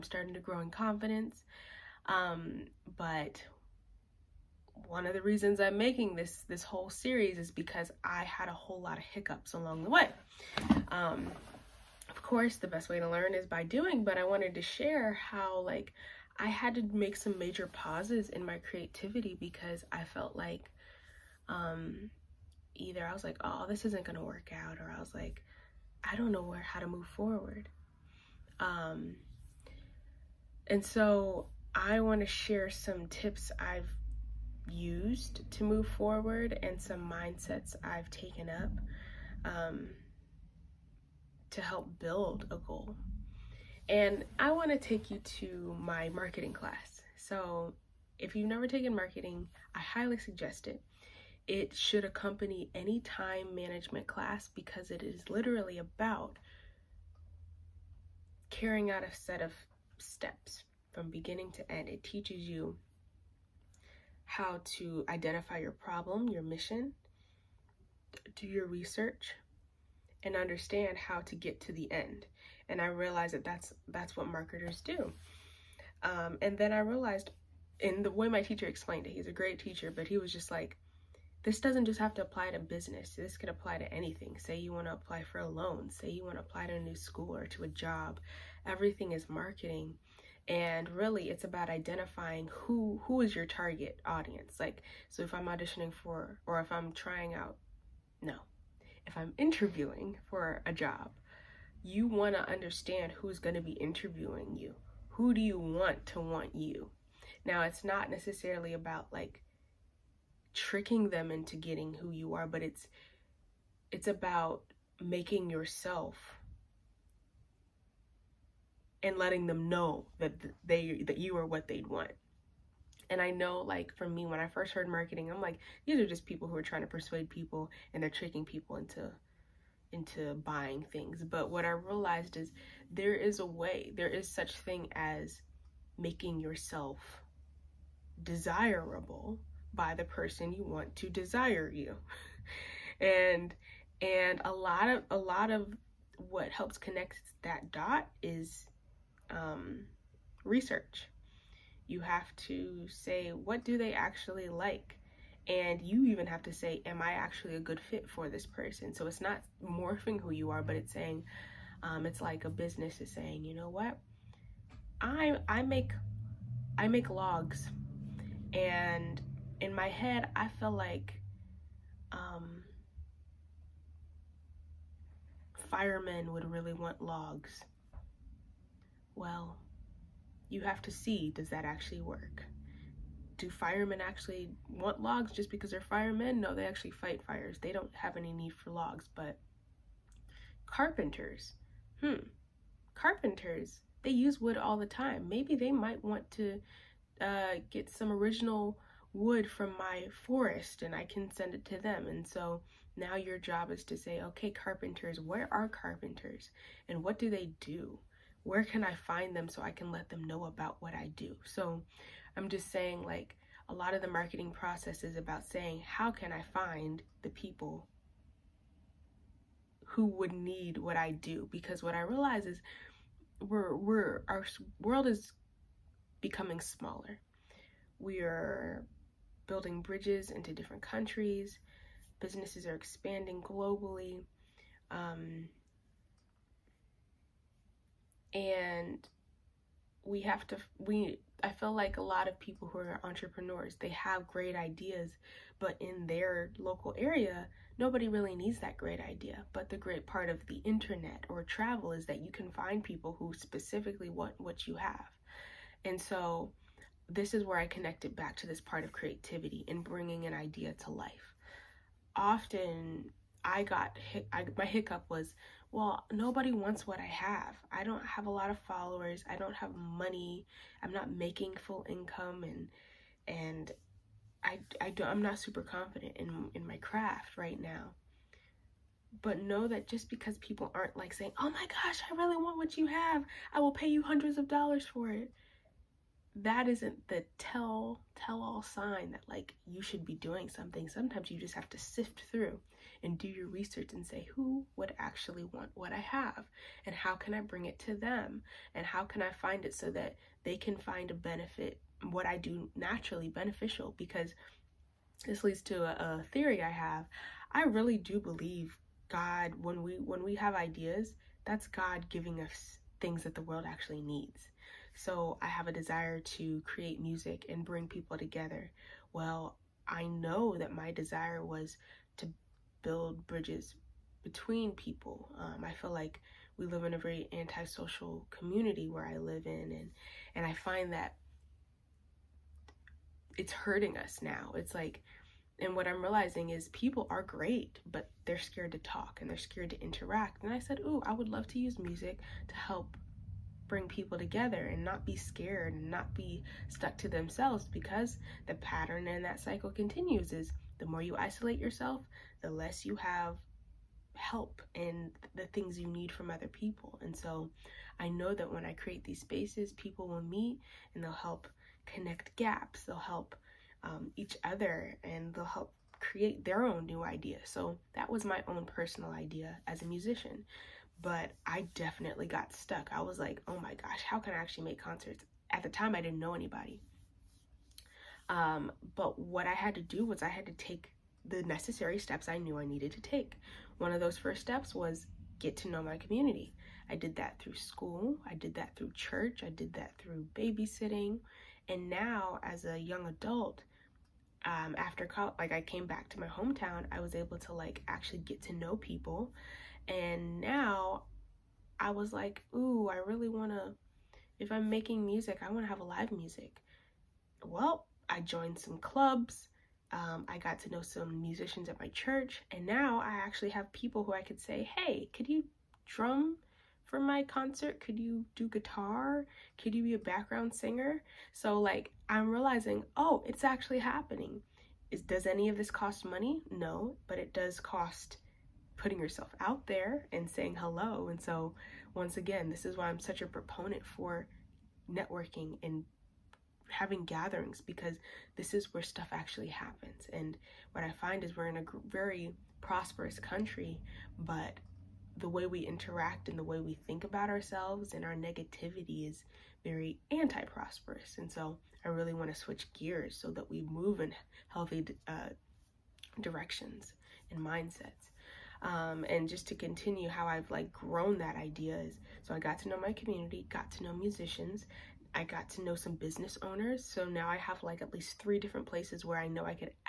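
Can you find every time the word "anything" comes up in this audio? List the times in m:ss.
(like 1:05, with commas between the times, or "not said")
1:23.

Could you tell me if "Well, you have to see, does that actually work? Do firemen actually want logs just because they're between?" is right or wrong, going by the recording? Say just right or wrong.
wrong.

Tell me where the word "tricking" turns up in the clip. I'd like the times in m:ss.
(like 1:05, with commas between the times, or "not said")
1:50, 2:08.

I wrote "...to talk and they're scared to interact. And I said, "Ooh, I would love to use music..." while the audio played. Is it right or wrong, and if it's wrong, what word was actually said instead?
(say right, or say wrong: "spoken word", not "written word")
right.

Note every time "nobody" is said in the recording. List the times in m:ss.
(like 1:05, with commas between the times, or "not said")
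4:07, 4:26.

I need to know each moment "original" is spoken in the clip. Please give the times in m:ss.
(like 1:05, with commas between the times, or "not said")
3:18.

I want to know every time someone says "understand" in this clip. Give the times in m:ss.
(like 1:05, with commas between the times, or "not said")
1:10, 1:42.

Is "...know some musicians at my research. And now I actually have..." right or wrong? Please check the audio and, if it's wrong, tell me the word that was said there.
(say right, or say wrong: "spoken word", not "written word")
wrong: "church", not "research".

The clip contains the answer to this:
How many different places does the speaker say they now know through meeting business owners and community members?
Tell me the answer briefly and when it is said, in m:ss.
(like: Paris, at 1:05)
3, at 7:48.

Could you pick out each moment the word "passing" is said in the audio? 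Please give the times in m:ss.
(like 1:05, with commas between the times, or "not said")
not said.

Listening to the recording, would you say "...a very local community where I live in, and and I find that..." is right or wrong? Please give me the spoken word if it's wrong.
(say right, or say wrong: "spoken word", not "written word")
wrong: "antisocial", not "local".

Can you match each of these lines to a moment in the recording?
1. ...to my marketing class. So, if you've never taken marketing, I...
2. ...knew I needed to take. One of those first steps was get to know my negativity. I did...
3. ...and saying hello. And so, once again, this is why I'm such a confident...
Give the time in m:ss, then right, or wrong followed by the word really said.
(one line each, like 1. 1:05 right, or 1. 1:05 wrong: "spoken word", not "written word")
1. 0:45 right
2. 6:22 wrong: "community", not "negativity"
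3. 7:10 wrong: "proponent", not "confident".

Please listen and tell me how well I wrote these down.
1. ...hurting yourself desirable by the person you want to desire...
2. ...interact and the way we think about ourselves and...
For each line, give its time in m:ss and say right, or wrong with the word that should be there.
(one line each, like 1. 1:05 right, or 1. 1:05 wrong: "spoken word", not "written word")
1. 2:15 wrong: "making", not "hurting"
2. 7:25 right.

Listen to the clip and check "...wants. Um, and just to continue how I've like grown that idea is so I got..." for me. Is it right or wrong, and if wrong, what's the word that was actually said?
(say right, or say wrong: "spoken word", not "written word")
wrong: "mindsets", not "wants".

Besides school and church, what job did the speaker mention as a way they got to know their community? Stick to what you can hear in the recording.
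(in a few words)
Babysitting.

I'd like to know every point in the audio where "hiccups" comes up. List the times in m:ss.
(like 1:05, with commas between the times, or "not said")
0:09, 4:24.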